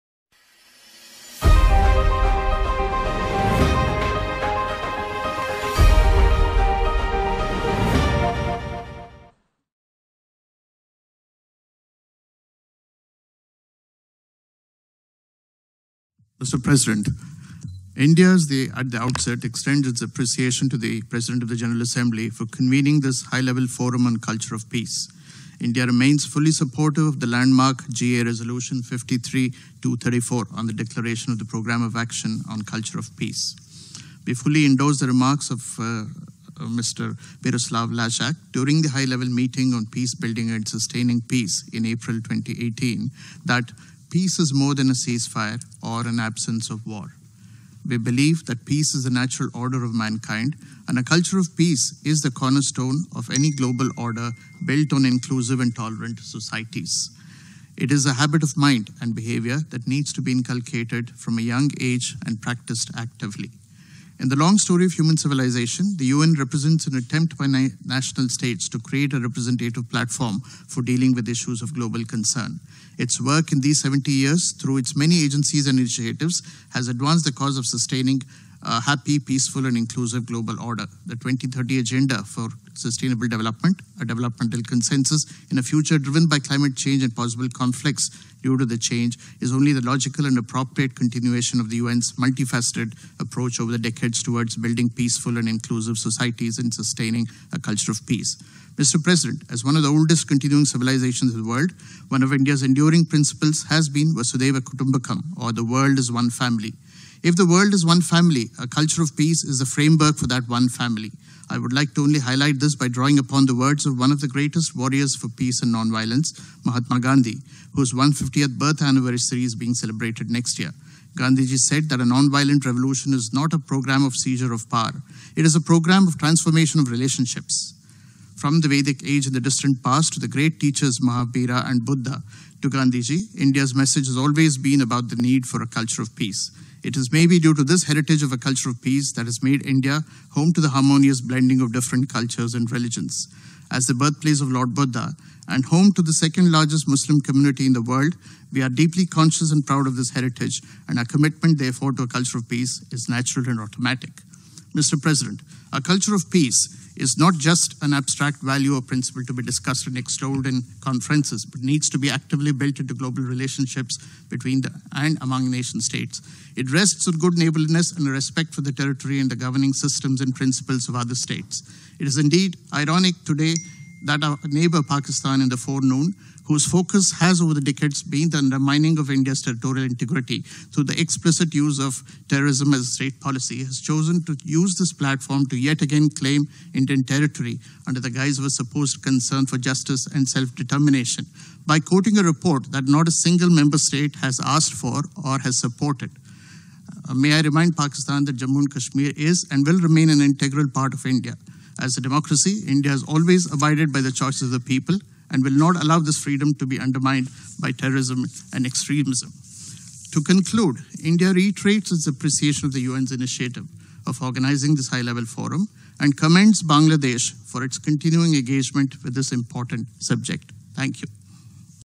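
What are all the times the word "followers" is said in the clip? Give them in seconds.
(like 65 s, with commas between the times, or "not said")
not said.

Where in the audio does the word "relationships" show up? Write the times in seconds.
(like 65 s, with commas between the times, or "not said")
126 s, 163 s.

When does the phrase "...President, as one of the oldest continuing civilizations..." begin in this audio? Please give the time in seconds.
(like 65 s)
99 s.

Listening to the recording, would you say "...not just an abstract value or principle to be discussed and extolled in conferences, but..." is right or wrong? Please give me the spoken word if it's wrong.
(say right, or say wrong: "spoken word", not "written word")
right.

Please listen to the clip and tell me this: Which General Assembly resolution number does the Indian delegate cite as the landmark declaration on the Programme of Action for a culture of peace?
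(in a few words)
53-234.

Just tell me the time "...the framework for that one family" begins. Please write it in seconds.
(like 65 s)
109 s.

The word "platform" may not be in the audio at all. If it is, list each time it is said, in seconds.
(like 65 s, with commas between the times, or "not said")
69 s, 184 s.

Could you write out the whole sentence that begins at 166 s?
It rests on good neighborliness and a respect for the territory and the governing systems and principles of other states.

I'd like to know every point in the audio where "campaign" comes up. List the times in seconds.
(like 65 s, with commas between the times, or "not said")
not said.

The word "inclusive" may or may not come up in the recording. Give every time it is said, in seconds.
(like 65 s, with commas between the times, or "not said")
55 s, 79 s, 95 s.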